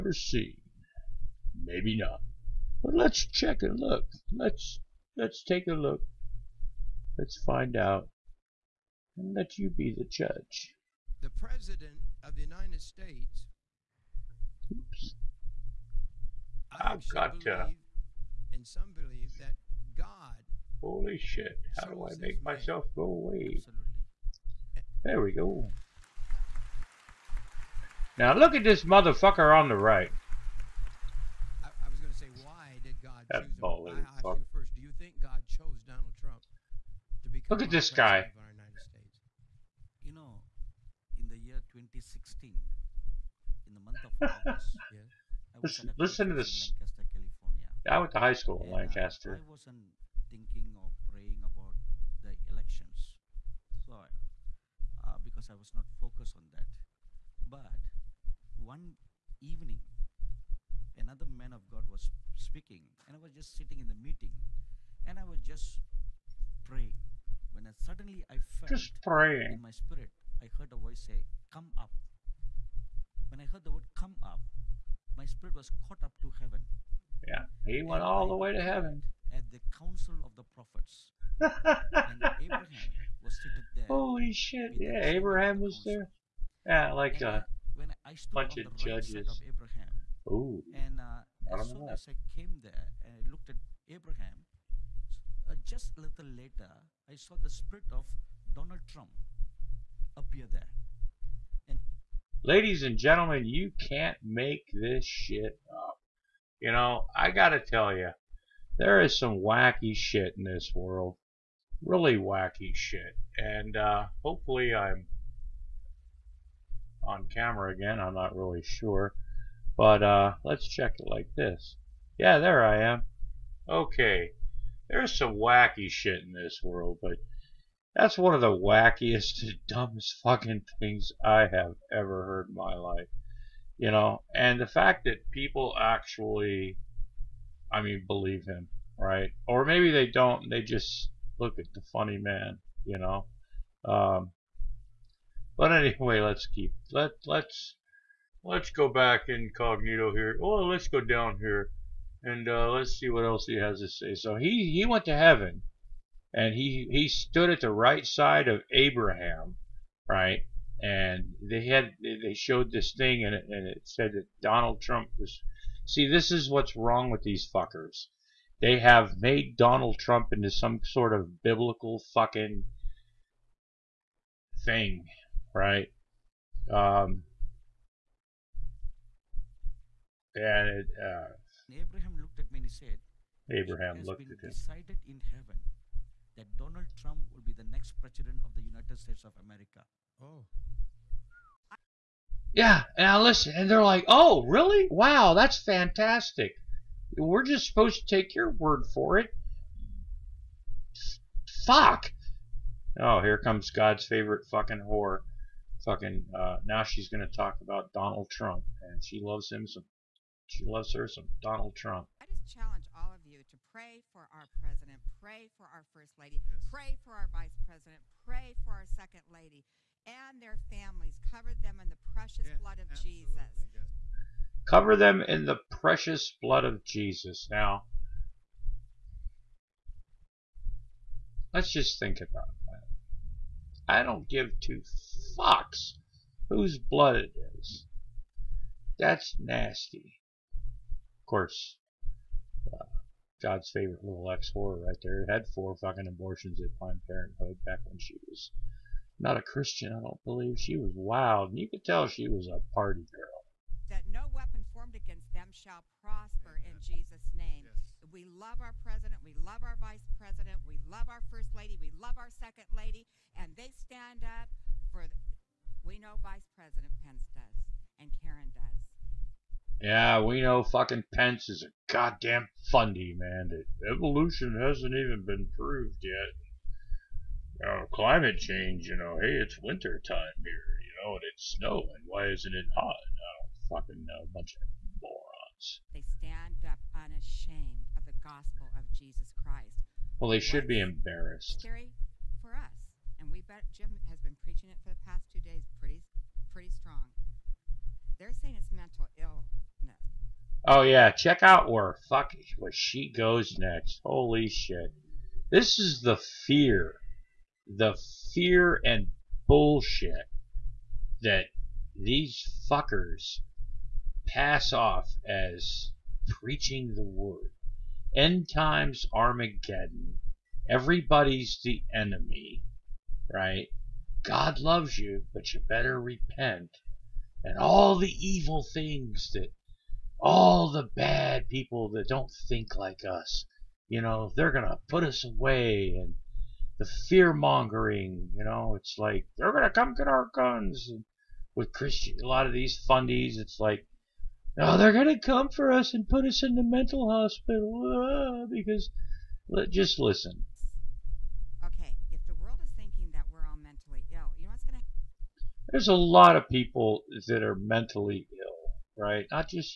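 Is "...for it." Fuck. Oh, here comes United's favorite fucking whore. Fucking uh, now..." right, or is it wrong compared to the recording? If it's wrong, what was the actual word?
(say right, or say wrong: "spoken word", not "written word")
wrong: "God", not "United".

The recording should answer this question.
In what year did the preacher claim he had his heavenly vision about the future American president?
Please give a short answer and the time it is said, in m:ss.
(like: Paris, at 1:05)
2016, at 0:41.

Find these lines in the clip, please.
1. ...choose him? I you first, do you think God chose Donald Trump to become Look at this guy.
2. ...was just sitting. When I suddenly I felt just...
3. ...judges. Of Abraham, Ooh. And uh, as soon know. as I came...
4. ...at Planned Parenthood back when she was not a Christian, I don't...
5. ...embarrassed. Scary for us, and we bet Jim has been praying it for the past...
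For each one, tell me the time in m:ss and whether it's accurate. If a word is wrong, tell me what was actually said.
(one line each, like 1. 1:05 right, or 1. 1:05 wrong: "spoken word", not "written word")
1. 0:33 right
2. 1:05 wrong: "praying", not "sitting"
3. 1:28 right
4. 4:06 right
5. 4:50 wrong: "preaching", not "praying".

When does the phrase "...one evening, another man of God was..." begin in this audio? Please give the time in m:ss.
0:58.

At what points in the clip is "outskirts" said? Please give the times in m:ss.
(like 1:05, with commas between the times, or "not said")
not said.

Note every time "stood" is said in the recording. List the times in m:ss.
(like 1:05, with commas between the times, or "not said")
2:37.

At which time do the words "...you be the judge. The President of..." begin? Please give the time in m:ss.
0:09.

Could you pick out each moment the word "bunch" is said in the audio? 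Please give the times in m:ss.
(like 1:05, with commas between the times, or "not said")
1:28, 4:44.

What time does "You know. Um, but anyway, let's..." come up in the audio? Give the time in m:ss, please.
2:22.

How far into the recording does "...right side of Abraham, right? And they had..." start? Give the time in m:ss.
2:37.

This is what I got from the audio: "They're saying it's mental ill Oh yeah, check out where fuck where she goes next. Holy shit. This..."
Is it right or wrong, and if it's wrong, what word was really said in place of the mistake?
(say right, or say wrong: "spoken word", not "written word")
right.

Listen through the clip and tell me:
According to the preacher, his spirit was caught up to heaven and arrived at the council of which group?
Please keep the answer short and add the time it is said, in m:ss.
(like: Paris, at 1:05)
prophets, at 1:20.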